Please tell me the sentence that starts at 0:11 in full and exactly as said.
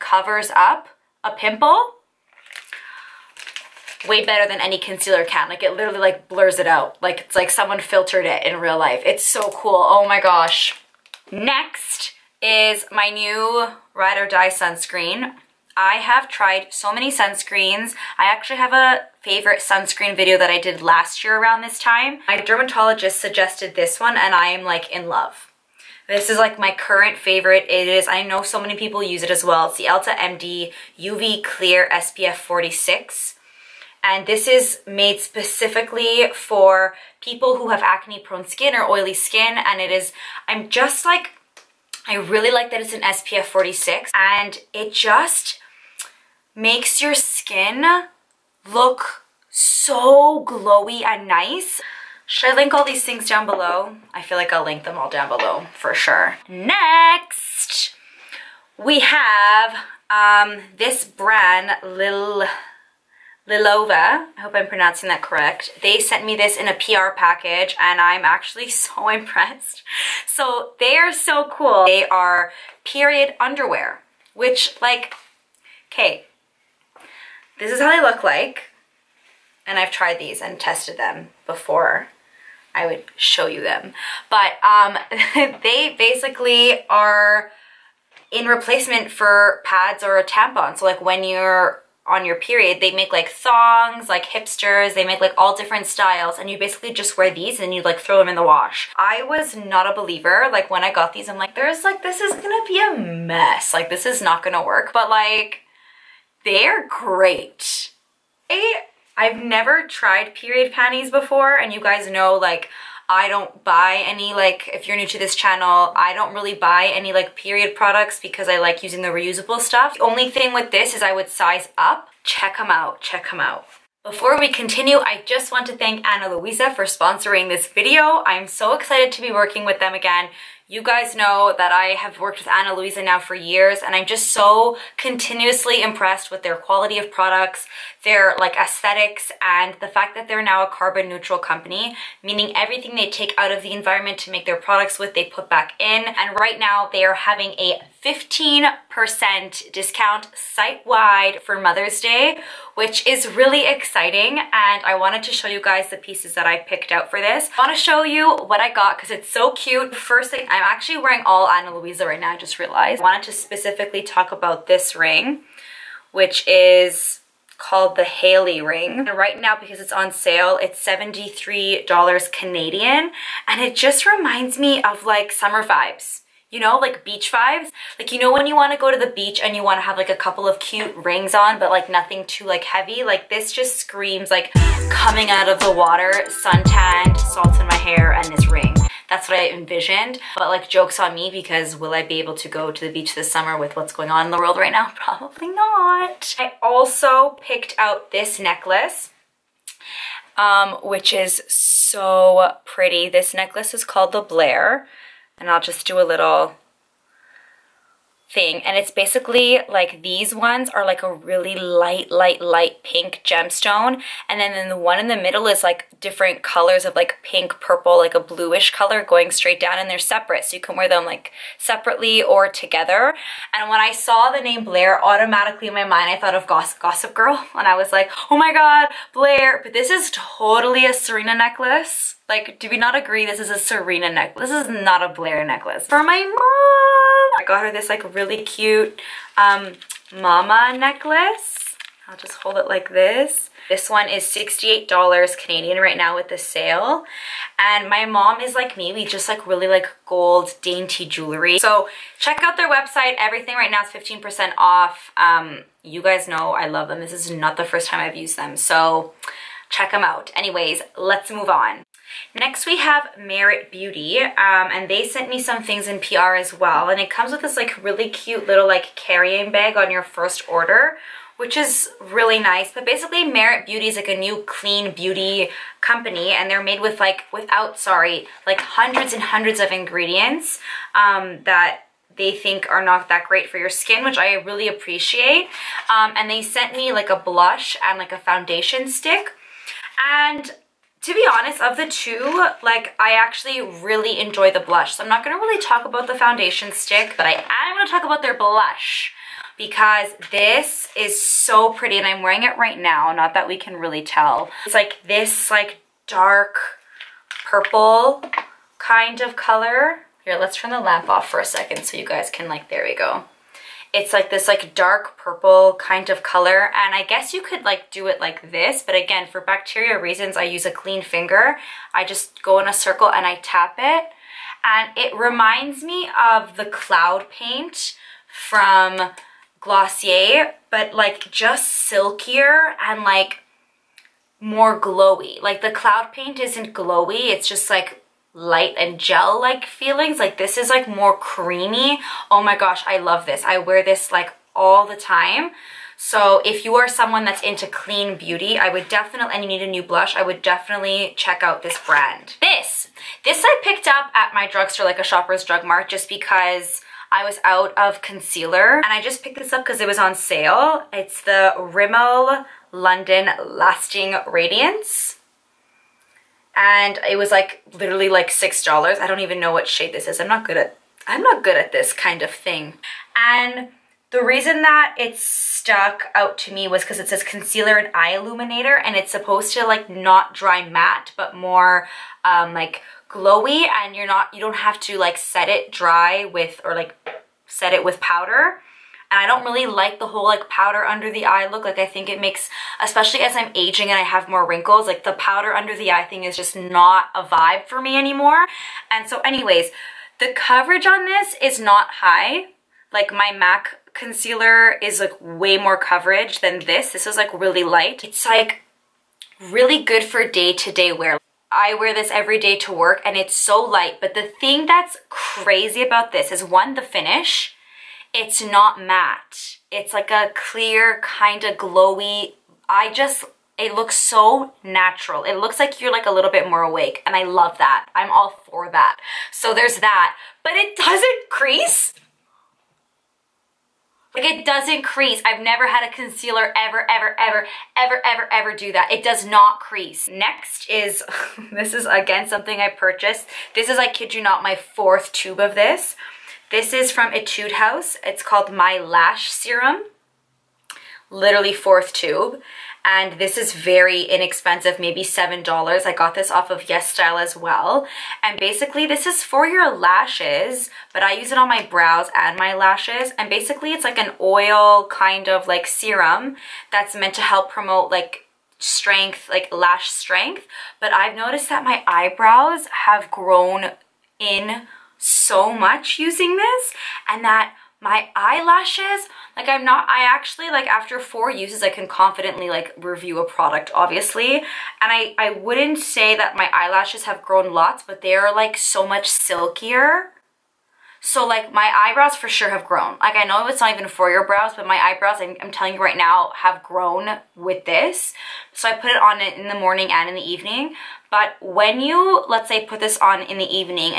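Next is my new Ride or Die sunscreen I have tried so many sunscreens.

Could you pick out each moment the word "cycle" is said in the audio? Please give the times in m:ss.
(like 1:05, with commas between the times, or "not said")
not said.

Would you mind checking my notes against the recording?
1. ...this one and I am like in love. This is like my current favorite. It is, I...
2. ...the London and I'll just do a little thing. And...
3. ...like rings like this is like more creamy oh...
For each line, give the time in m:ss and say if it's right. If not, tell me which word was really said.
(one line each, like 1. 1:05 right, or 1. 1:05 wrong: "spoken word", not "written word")
1. 0:23 right
2. 3:24 wrong: "Blaire", not "London"
3. 5:39 wrong: "feelings", not "rings".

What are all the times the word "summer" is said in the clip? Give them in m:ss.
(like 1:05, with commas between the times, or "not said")
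2:55, 3:13.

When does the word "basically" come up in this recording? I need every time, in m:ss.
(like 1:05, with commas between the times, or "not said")
1:25, 1:36, 3:28, 4:32, 7:38, 7:43.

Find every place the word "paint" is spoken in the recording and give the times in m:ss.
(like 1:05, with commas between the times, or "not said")
5:27, 5:36.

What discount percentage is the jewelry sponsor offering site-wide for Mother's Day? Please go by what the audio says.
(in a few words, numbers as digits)
15%.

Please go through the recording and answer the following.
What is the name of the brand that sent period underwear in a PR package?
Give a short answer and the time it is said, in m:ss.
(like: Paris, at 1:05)
Lilova, at 1:03.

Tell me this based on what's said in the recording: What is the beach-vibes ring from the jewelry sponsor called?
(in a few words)
Hailey ring.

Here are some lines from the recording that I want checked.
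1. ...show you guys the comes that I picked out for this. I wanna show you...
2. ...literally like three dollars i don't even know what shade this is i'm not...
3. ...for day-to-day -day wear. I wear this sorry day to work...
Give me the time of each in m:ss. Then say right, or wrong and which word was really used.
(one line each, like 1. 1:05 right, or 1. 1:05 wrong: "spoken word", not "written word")
1. 2:35 wrong: "pieces", not "comes"
2. 6:07 wrong: "six", not "three"
3. 6:50 wrong: "every", not "sorry".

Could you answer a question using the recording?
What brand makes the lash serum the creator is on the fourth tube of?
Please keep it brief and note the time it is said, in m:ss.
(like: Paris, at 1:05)
Etude House, at 7:27.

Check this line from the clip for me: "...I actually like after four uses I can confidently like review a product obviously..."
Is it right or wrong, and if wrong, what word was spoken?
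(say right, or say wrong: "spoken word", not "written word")
right.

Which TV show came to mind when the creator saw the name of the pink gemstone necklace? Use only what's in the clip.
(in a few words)
Gossip Girl.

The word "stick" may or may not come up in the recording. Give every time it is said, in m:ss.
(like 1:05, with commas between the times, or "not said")
4:48, 4:56.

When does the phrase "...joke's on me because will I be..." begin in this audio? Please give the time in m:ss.
3:10.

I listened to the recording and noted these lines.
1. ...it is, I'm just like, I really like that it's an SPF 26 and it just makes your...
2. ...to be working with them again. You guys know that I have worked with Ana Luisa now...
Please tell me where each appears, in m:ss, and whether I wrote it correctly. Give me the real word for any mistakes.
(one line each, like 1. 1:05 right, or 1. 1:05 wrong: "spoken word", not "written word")
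1. 0:39 wrong: "46", not "26"
2. 2:09 right.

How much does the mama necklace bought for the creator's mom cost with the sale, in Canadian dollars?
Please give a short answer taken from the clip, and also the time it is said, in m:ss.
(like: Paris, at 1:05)
$68, at 4:04.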